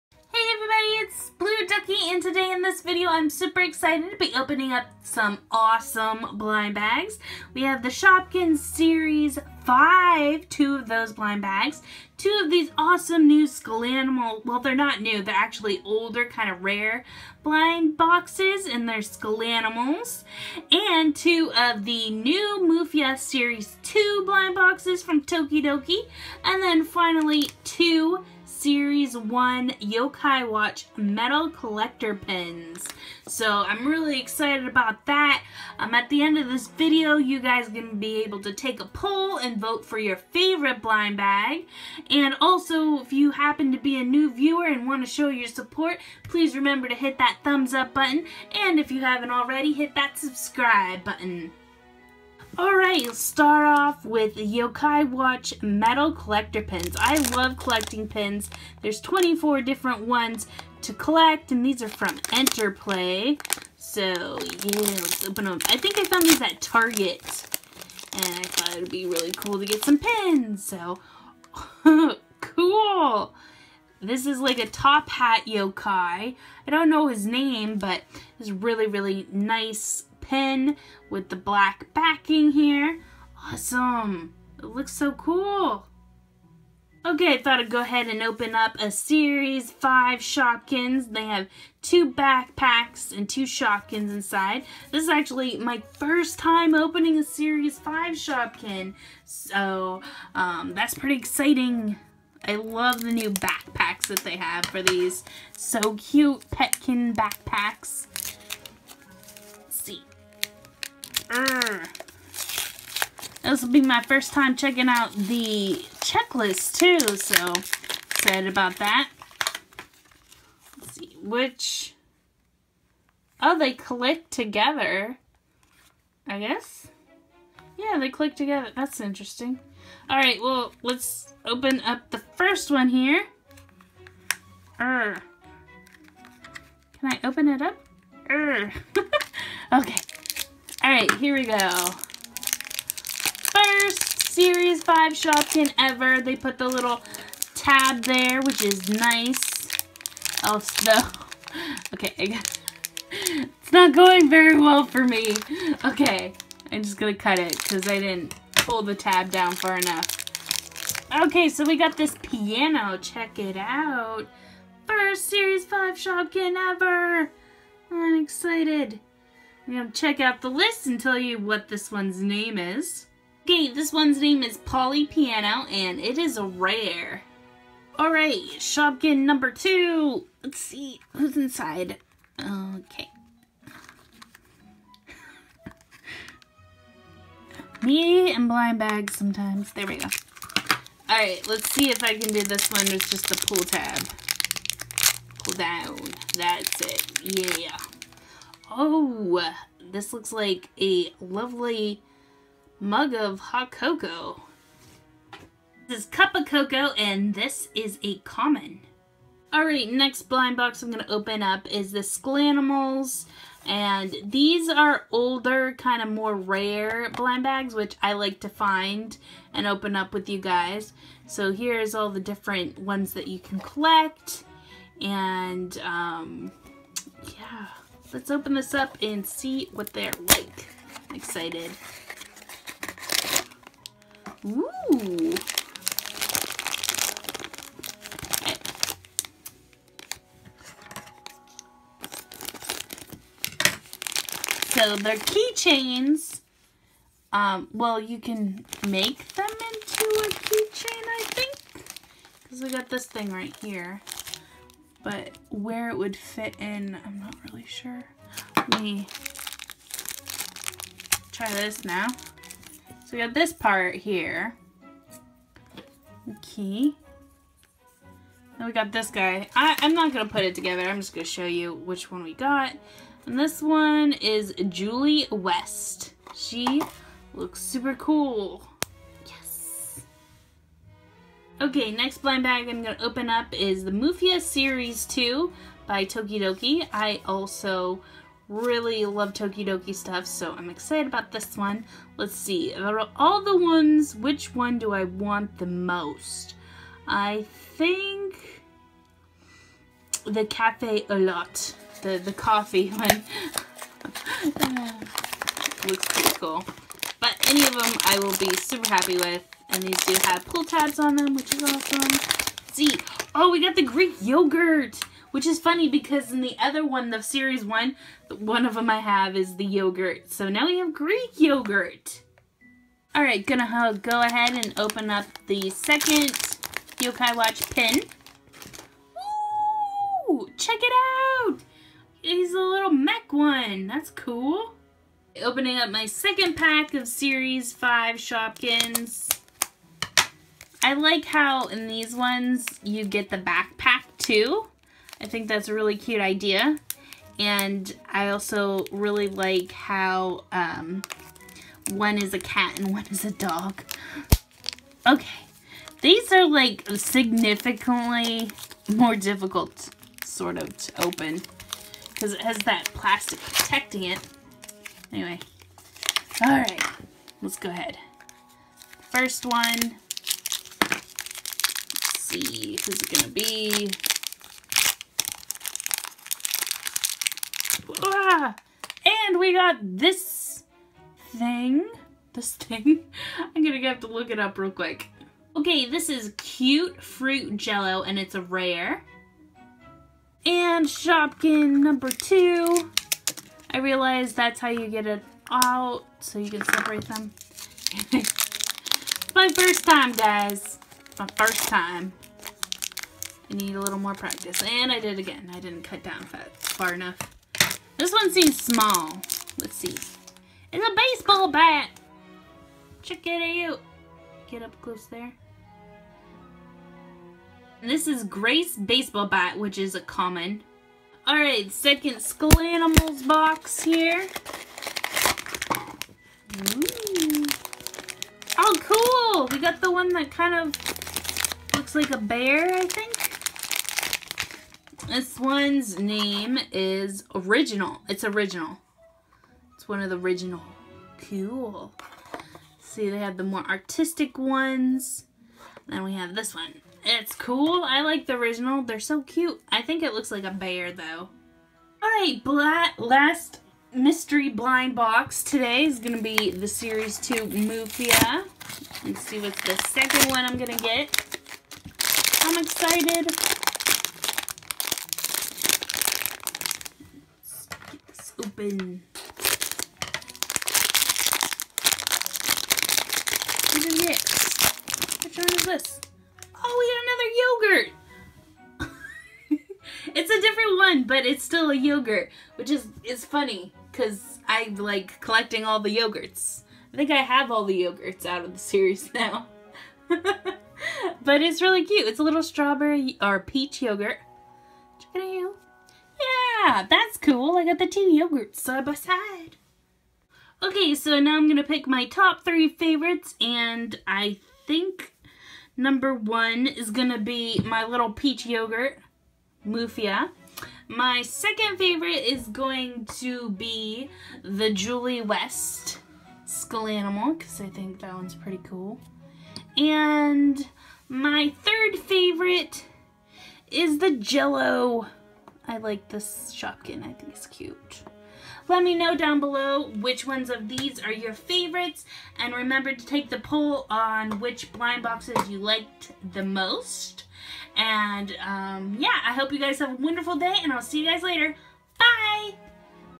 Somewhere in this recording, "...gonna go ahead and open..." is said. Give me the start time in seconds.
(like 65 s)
323 s.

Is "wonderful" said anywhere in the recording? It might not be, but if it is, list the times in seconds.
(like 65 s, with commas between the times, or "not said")
539 s.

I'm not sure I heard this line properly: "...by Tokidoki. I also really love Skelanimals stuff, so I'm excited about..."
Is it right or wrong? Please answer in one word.
wrong.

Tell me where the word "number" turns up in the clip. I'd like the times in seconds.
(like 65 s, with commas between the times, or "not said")
179 s, 391 s, 505 s.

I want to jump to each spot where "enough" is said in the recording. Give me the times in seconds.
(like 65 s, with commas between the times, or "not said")
159 s, 406 s.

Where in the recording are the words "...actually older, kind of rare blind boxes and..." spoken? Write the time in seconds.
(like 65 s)
15 s.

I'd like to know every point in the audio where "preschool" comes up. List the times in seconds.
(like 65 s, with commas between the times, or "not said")
not said.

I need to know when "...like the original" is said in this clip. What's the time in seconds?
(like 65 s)
448 s.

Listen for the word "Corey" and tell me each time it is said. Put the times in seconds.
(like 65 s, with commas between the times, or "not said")
not said.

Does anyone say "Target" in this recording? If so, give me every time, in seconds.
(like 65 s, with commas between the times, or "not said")
66 s.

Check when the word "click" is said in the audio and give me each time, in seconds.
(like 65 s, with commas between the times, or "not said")
123 s, 128 s.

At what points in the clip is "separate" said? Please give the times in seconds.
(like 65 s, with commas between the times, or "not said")
396 s.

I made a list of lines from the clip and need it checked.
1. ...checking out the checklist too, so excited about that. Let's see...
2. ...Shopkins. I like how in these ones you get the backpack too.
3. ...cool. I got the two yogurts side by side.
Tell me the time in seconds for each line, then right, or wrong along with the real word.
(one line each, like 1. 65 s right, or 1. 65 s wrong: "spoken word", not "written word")
1. 114 s right
2. 338 s right
3. 497 s right.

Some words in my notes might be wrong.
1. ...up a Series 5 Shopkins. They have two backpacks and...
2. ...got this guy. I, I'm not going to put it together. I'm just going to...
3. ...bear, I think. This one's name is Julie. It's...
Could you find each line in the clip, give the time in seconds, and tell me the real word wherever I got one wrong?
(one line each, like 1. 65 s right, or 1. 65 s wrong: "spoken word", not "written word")
1. 88 s right
2. 268 s right
3. 432 s wrong: "Original", not "Julie".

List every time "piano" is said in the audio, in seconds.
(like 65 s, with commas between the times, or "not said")
162 s, 175 s.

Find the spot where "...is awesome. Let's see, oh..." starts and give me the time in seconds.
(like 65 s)
311 s.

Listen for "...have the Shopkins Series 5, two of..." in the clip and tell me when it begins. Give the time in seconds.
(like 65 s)
7 s.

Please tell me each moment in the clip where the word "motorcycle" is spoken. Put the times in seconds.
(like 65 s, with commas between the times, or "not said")
not said.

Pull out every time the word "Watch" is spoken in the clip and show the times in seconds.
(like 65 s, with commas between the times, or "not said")
30 s, 55 s, 327 s.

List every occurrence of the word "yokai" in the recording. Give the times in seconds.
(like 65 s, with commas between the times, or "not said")
29 s, 54 s, 75 s, 326 s.